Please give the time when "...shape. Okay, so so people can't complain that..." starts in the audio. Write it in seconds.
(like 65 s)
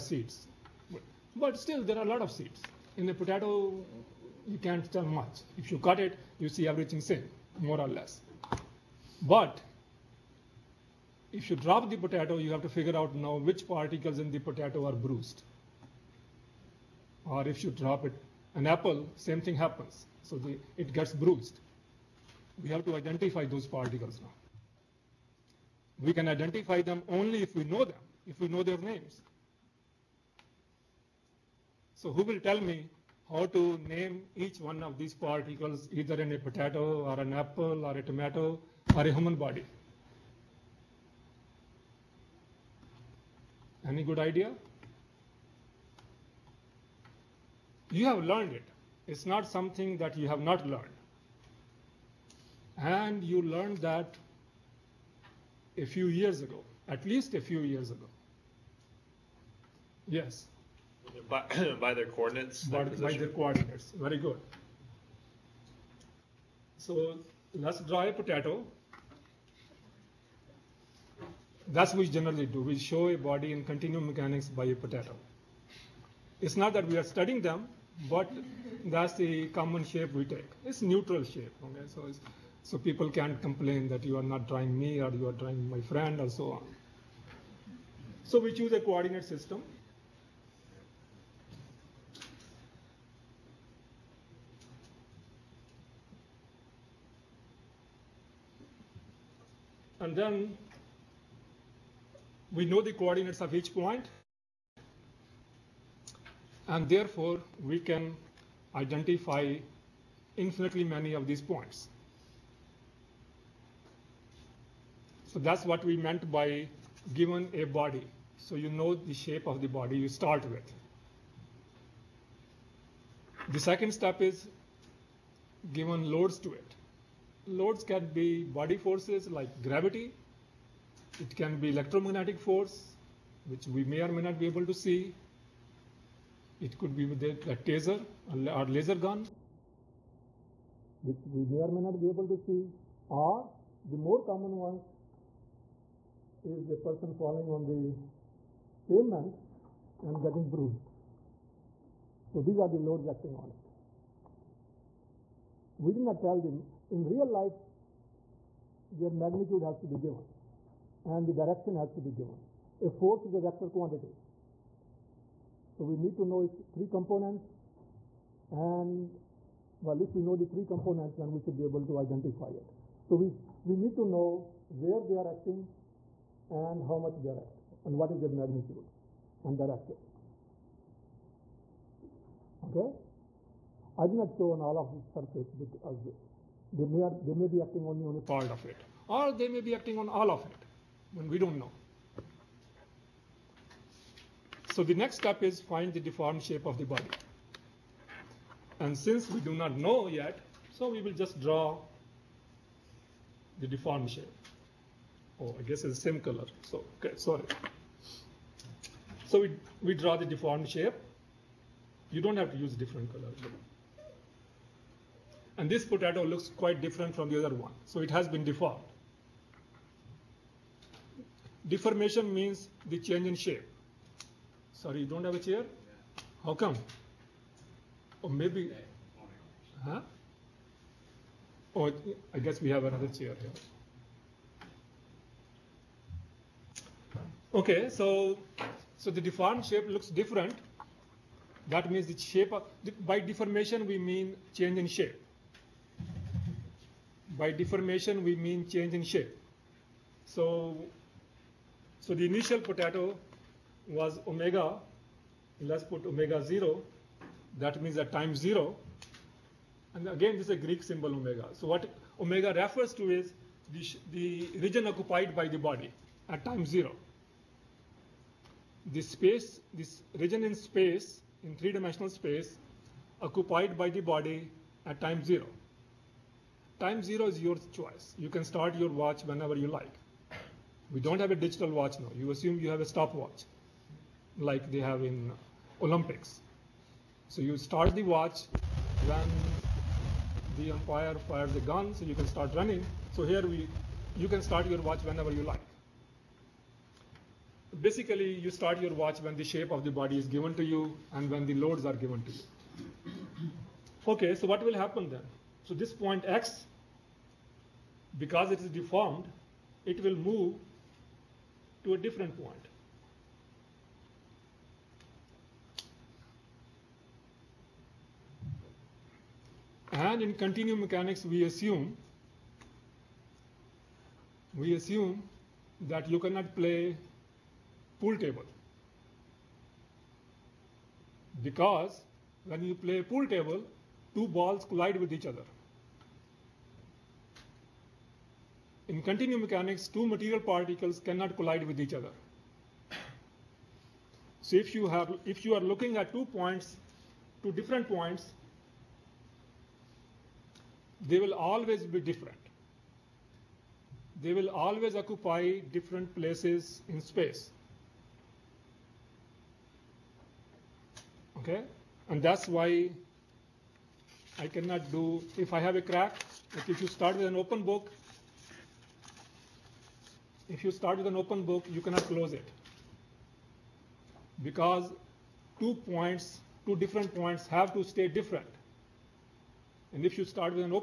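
81 s.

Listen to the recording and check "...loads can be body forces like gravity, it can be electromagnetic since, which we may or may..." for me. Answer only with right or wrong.
wrong.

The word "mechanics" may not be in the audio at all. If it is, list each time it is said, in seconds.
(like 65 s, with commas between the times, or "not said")
74 s, 320 s, 339 s.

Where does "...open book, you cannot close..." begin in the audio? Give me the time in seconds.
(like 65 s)
371 s.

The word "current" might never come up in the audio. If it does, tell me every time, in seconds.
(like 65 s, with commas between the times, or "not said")
not said.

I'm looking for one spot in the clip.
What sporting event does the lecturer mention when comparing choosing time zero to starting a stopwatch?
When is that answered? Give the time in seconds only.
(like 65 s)
285 s.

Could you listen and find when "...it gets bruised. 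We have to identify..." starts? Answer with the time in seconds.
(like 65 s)
20 s.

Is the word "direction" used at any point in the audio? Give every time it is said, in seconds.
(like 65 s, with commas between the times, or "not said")
161 s, 179 s.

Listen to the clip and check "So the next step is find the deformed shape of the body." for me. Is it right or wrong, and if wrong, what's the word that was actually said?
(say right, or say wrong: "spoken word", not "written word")
right.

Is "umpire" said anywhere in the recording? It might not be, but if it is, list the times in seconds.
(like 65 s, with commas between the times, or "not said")
290 s.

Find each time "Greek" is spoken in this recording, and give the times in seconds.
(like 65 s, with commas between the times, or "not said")
260 s.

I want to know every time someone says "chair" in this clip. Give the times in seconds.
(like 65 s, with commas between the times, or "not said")
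225 s, 233 s.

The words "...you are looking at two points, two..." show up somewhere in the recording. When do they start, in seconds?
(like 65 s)
345 s.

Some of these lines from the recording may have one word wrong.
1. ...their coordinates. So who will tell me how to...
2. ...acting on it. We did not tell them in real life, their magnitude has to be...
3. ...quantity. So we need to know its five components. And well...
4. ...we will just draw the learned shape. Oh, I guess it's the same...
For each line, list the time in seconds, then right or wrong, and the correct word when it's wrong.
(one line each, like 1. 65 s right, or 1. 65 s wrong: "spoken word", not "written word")
1. 28 s wrong: "names", not "coordinates"
2. 153 s right
3. 163 s wrong: "three", not "five"
4. 200 s wrong: "deformed", not "learned".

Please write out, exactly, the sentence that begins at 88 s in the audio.
So we choose a coordinate system.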